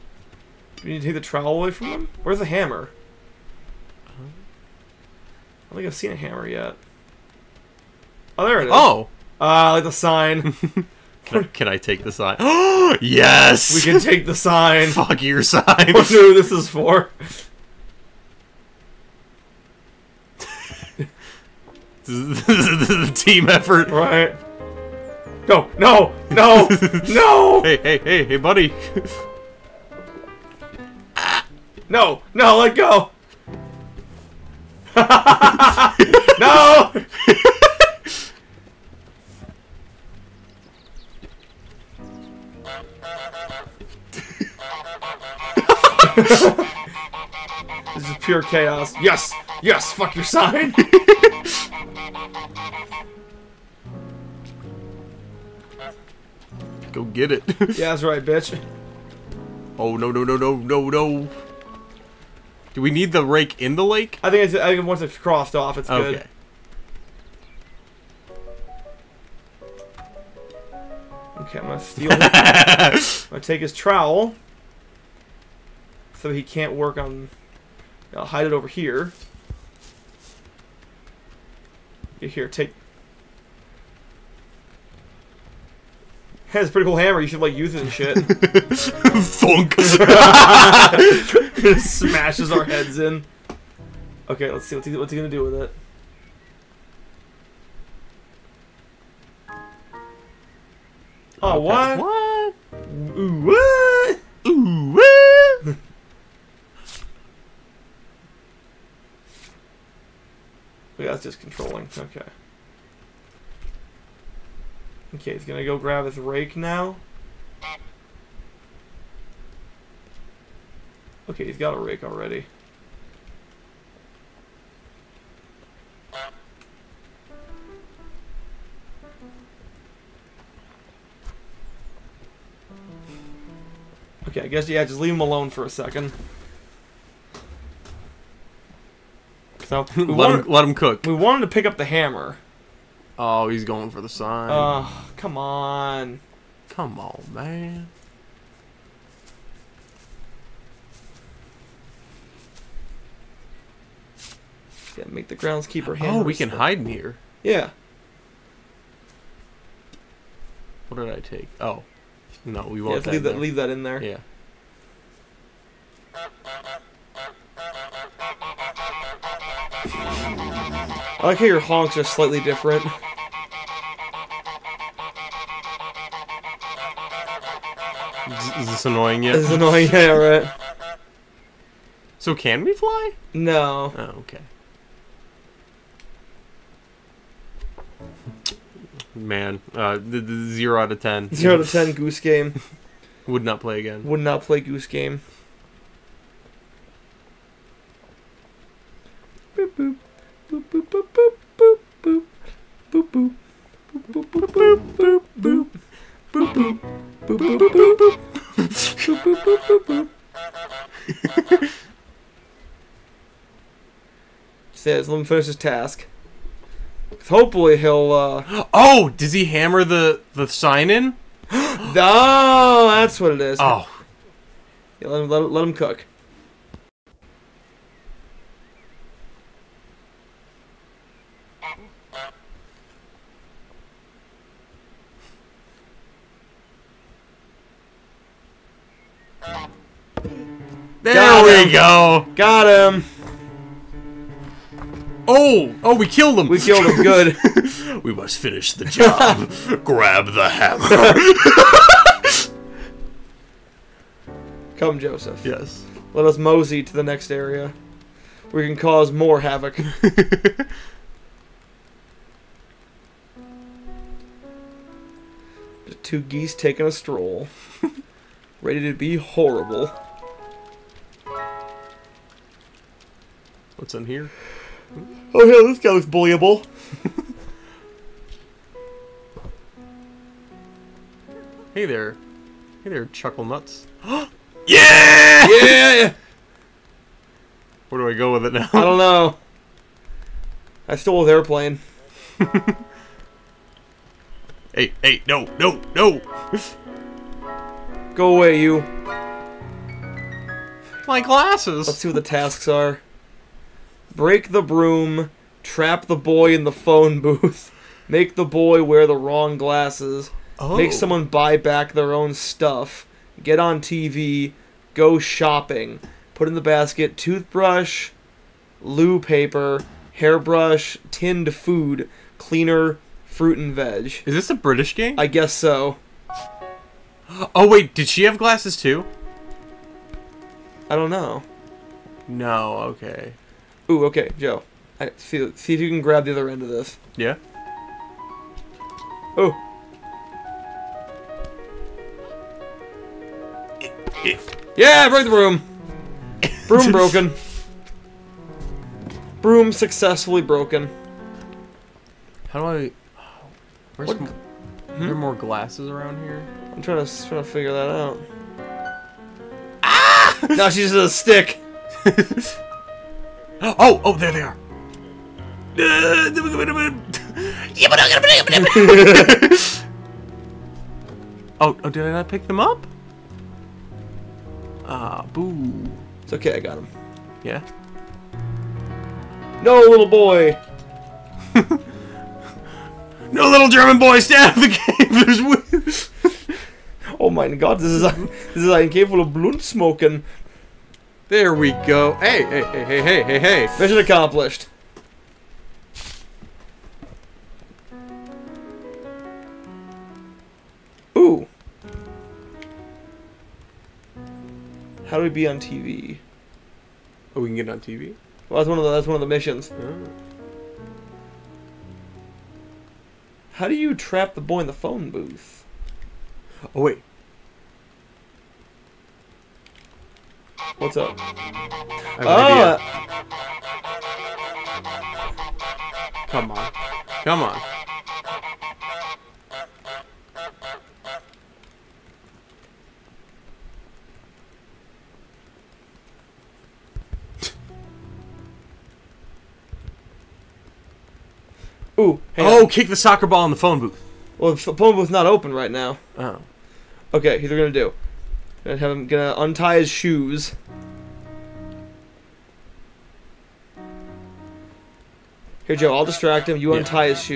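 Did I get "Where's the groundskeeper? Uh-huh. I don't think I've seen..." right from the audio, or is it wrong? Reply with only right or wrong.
wrong.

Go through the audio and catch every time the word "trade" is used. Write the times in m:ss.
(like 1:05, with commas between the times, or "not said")
not said.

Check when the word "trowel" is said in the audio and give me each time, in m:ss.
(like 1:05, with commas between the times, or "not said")
0:01, 1:13.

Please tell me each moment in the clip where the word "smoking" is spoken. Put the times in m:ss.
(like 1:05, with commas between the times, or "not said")
6:29.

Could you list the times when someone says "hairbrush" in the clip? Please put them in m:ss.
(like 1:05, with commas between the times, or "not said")
5:20.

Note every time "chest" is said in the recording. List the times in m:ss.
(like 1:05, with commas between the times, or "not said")
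not said.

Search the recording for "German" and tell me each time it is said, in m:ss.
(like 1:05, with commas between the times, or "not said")
6:23.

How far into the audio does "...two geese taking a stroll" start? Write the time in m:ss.
4:26.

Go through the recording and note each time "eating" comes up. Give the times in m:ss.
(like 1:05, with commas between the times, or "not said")
not said.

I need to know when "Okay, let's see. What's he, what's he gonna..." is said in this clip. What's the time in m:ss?
1:34.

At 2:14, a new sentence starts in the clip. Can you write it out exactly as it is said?
Okay, I guess, yeah, just leave him alone for a second.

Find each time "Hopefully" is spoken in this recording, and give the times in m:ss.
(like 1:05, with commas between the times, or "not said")
3:37.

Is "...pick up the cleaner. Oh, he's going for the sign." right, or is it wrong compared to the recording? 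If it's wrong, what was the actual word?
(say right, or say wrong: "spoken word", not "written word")
wrong: "hammer", not "cleaner".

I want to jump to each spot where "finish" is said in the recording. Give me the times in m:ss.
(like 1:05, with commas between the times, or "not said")
3:35, 4:08.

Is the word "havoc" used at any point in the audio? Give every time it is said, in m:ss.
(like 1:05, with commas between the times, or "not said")
4:19.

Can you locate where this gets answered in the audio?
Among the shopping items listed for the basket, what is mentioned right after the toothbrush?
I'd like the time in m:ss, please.
5:18.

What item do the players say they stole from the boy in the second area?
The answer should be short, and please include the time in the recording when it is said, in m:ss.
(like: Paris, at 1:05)
his airplane, at 4:51.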